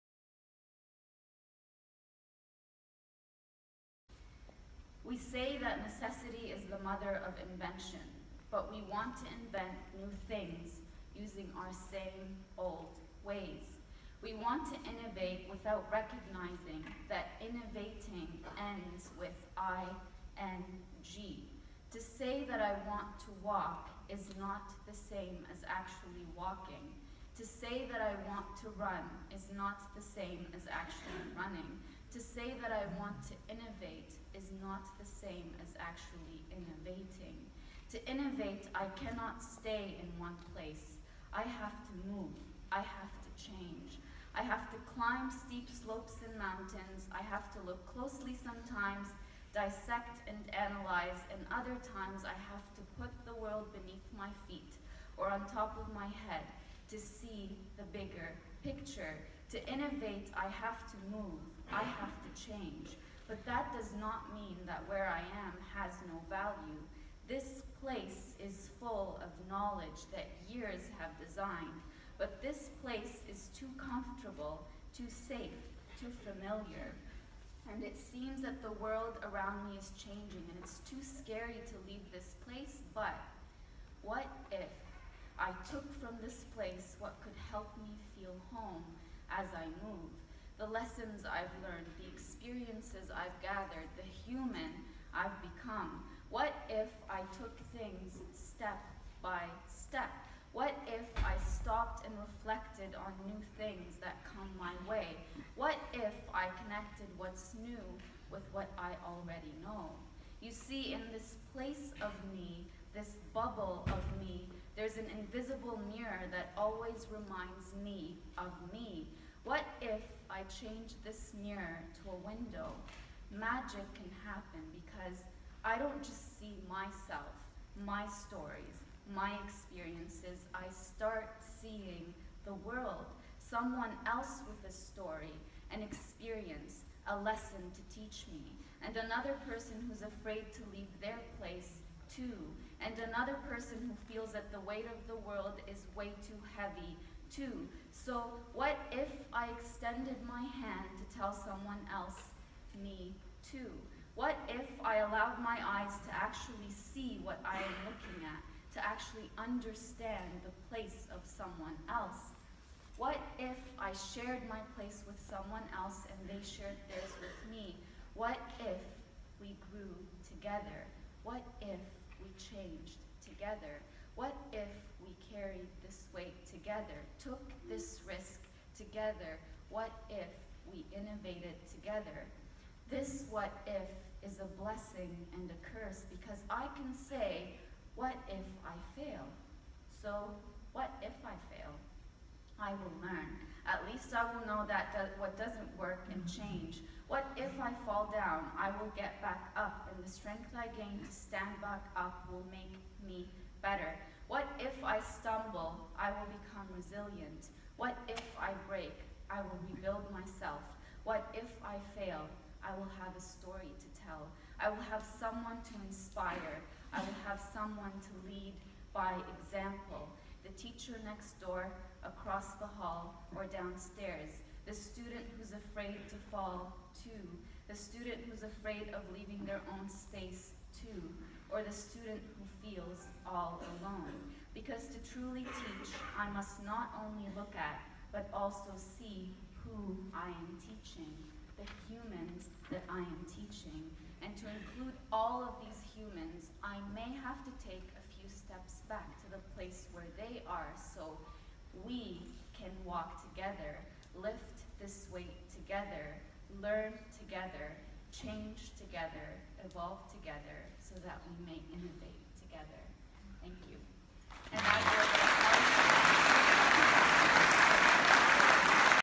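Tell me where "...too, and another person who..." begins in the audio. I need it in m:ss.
2:22.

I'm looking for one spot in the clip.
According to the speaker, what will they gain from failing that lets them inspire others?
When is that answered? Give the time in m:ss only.
3:33.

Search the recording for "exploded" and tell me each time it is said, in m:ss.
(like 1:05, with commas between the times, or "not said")
not said.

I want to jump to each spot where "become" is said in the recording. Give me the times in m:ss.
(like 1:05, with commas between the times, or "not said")
1:35, 3:26.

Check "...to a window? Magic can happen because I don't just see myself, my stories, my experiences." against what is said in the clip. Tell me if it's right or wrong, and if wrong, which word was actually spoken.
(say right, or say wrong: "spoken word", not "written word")
right.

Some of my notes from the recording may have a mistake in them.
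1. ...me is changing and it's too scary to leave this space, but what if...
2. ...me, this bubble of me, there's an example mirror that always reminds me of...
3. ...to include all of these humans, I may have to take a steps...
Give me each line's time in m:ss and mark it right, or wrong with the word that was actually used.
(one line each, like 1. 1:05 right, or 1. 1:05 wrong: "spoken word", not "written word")
1. 1:19 wrong: "place", not "space"
2. 1:52 wrong: "invisible", not "example"
3. 4:04 right.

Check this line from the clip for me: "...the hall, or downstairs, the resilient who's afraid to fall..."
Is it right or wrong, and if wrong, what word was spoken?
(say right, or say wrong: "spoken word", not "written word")
wrong: "student", not "resilient".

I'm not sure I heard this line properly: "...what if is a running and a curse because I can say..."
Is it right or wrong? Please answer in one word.
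wrong.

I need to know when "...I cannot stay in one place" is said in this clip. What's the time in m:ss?
0:38.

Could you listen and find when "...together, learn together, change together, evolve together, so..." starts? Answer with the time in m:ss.
4:15.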